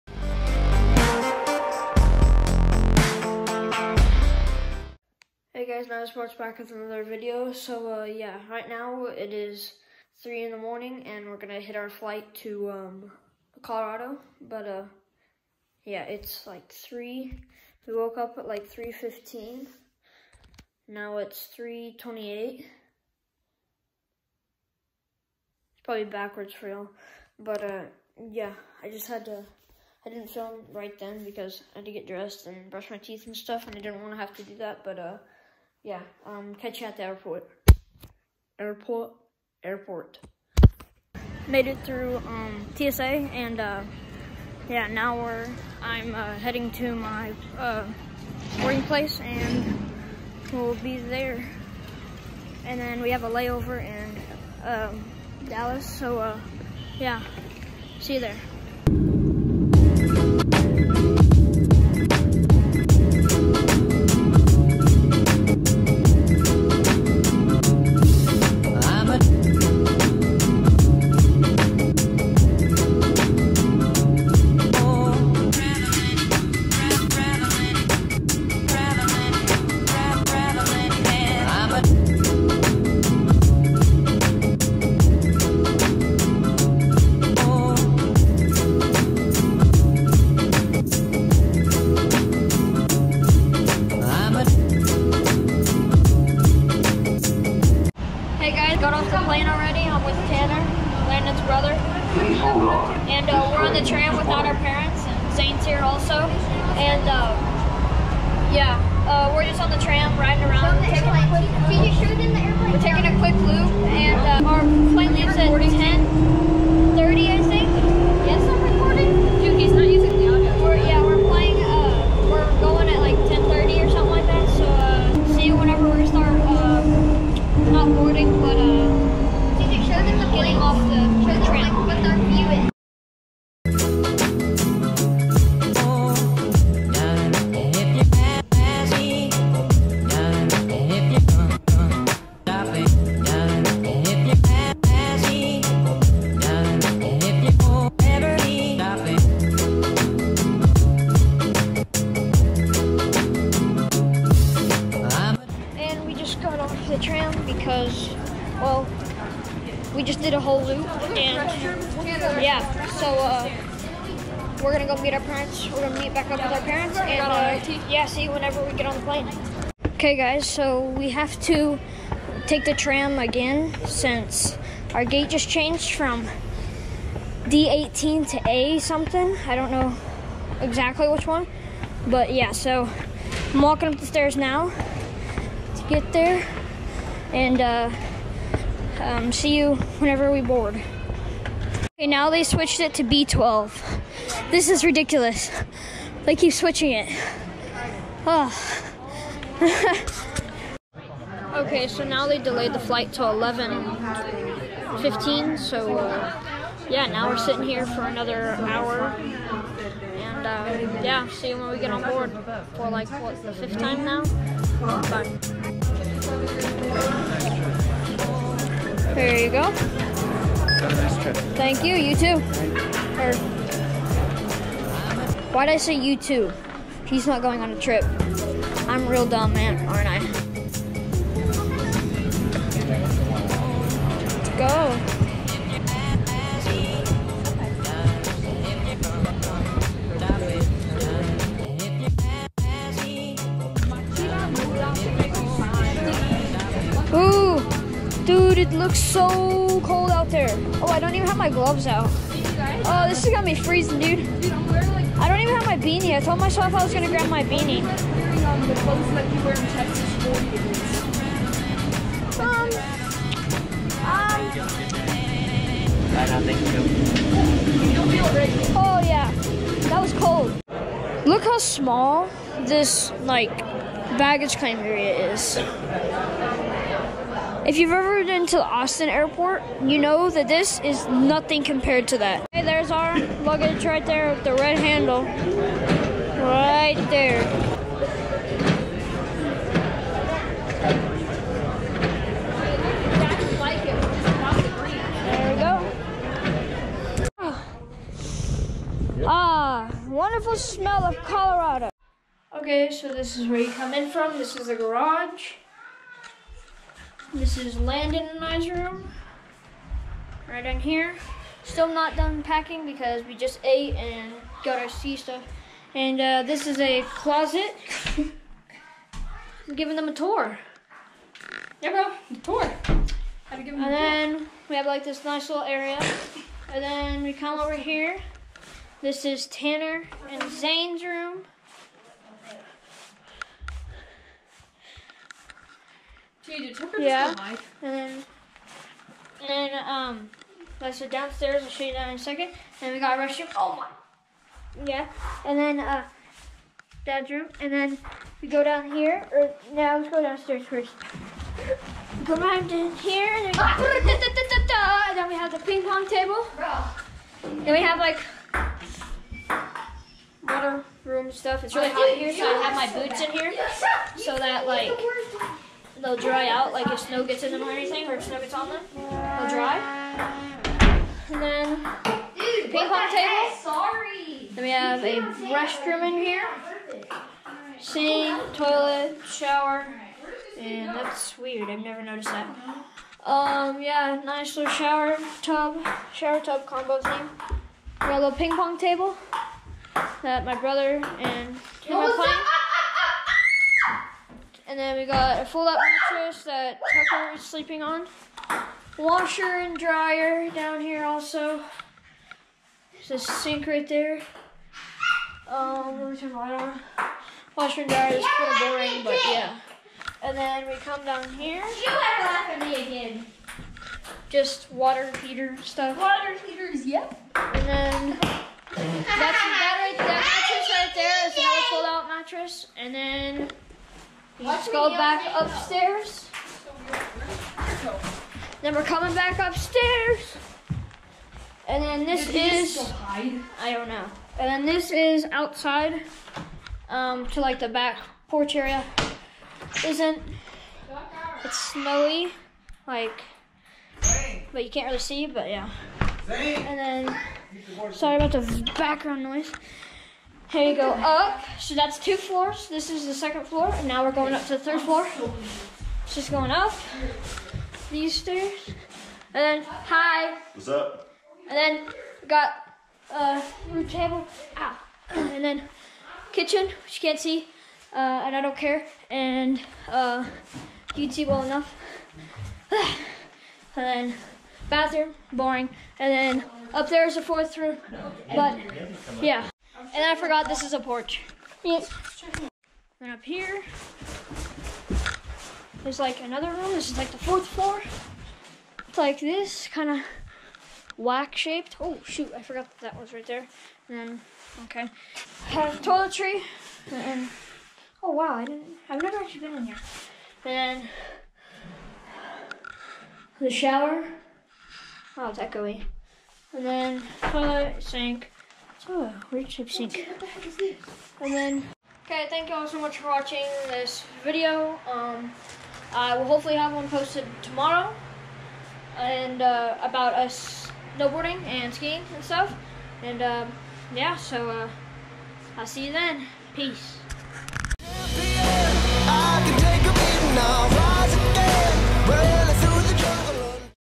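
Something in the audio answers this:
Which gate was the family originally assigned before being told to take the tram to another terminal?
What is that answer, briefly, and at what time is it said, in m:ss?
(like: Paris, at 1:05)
D18, at 2:57.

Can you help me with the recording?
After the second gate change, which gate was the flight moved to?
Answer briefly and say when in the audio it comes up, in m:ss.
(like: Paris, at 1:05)
B12, at 3:13.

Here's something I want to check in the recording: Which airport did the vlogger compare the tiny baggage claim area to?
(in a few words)
Austin airport.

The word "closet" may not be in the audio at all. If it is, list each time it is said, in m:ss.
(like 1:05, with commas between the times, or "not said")
5:17.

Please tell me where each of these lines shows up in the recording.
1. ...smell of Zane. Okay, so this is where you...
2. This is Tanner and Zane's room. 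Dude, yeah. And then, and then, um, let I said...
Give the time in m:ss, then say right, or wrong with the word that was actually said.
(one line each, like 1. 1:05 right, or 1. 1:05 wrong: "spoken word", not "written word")
1. 5:00 wrong: "Colorado", not "Zane"
2. 5:29 right.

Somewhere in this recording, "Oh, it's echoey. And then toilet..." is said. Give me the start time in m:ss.
8:25.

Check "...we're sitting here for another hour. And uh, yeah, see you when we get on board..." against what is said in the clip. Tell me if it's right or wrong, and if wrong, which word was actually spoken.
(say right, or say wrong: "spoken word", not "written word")
right.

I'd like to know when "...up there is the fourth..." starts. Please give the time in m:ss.
7:56.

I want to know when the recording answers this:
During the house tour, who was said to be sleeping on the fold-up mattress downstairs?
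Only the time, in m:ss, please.
6:37.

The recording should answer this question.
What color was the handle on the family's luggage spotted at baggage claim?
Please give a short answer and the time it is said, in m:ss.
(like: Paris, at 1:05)
red, at 4:44.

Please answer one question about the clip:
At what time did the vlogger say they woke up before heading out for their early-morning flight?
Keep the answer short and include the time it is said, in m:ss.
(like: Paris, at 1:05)
3:15, at 0:18.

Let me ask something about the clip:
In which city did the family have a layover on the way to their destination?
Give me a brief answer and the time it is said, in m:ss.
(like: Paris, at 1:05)
Dallas, at 0:55.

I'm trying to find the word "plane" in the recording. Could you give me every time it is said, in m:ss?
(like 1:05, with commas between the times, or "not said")
1:54, 2:49.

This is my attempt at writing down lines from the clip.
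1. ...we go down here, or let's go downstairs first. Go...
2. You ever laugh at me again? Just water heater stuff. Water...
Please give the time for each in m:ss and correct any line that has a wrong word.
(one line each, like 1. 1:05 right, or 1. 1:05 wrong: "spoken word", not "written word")
1. 5:48 right
2. 6:51 right.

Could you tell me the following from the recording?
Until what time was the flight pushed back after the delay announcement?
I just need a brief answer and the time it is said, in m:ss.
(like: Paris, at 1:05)
11:15, at 3:23.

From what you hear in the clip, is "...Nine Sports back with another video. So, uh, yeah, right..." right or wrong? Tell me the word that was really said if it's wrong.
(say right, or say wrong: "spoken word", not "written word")
right.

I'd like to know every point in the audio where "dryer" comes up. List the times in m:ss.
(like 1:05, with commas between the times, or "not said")
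6:39, 6:47.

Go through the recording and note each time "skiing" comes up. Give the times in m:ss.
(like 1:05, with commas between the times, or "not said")
8:41.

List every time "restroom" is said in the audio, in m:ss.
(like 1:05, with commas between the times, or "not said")
5:43, 6:15.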